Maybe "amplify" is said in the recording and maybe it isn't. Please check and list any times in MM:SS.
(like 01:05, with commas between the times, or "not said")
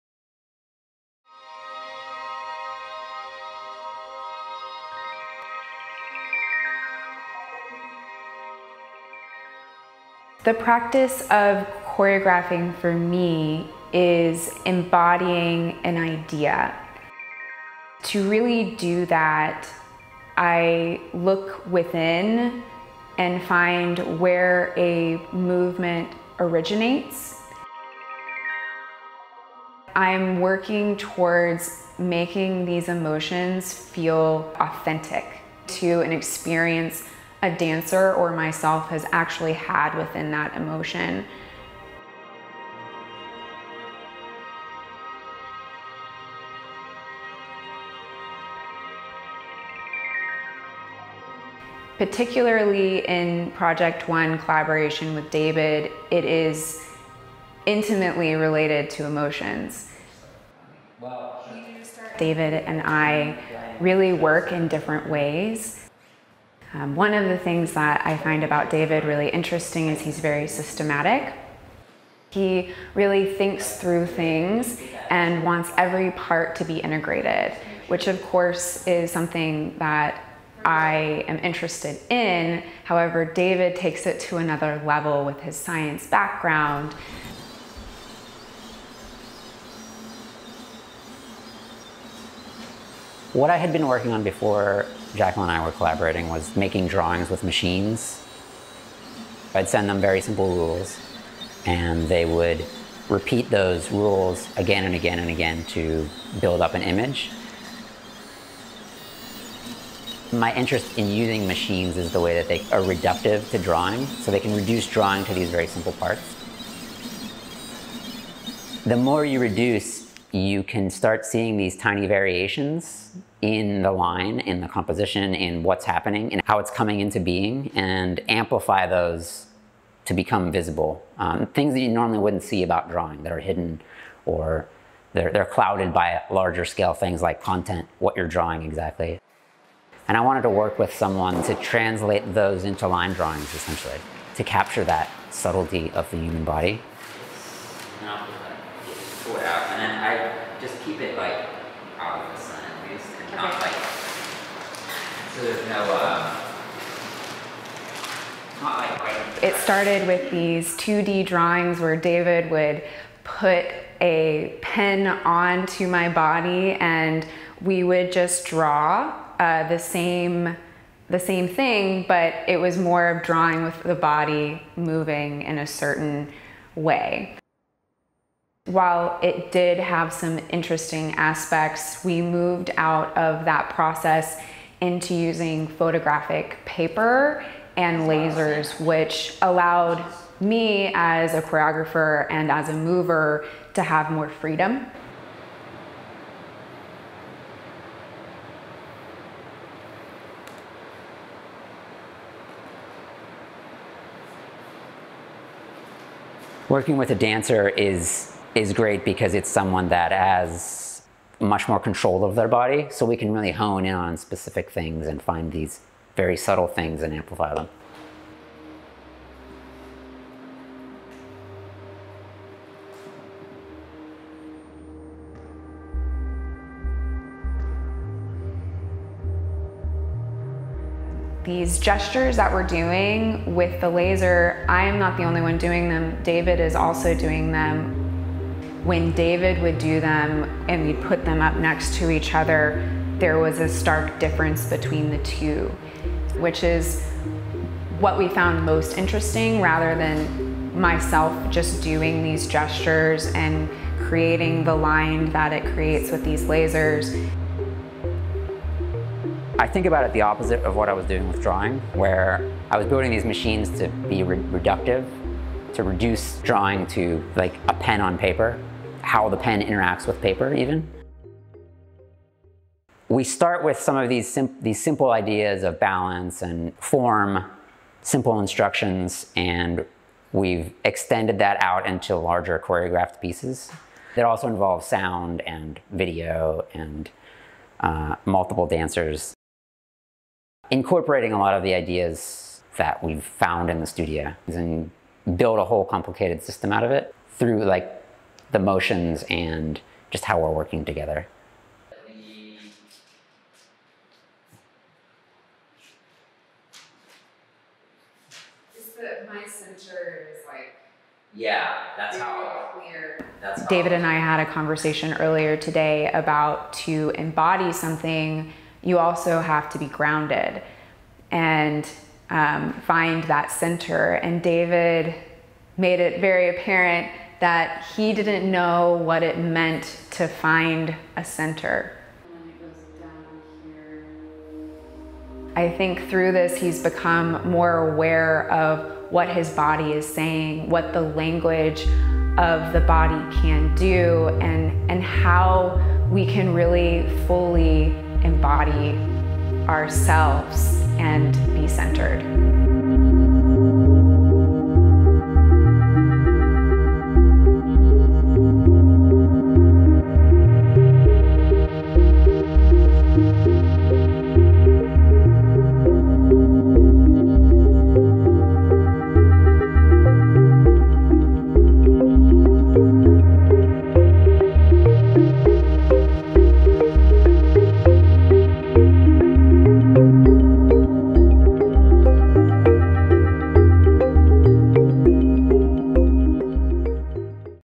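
02:08, 03:37.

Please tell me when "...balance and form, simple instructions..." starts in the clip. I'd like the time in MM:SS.
04:35.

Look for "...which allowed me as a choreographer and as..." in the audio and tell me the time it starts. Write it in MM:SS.
03:08.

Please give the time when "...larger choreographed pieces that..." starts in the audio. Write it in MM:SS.
04:42.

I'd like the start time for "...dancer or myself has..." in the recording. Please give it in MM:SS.
00:37.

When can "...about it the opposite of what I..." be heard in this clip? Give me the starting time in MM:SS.
04:19.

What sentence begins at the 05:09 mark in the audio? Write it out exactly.
my center is like yeah, that's how.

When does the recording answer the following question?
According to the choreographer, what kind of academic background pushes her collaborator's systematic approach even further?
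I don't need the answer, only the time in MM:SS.
01:25.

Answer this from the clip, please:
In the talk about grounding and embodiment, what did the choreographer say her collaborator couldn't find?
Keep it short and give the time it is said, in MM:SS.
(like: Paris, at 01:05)
a center, at 05:31.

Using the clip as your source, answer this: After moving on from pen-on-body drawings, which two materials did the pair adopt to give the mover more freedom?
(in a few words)
photographic paper and lasers.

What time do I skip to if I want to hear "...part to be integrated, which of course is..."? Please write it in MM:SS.
01:16.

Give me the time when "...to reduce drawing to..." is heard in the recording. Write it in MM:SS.
04:25.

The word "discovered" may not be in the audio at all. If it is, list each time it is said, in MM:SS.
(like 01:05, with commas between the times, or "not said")
not said.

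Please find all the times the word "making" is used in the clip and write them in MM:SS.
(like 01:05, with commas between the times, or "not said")
00:31, 01:36.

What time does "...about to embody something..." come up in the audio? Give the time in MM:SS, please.
05:16.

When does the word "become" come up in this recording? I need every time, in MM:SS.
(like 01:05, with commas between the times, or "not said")
02:10, 05:36.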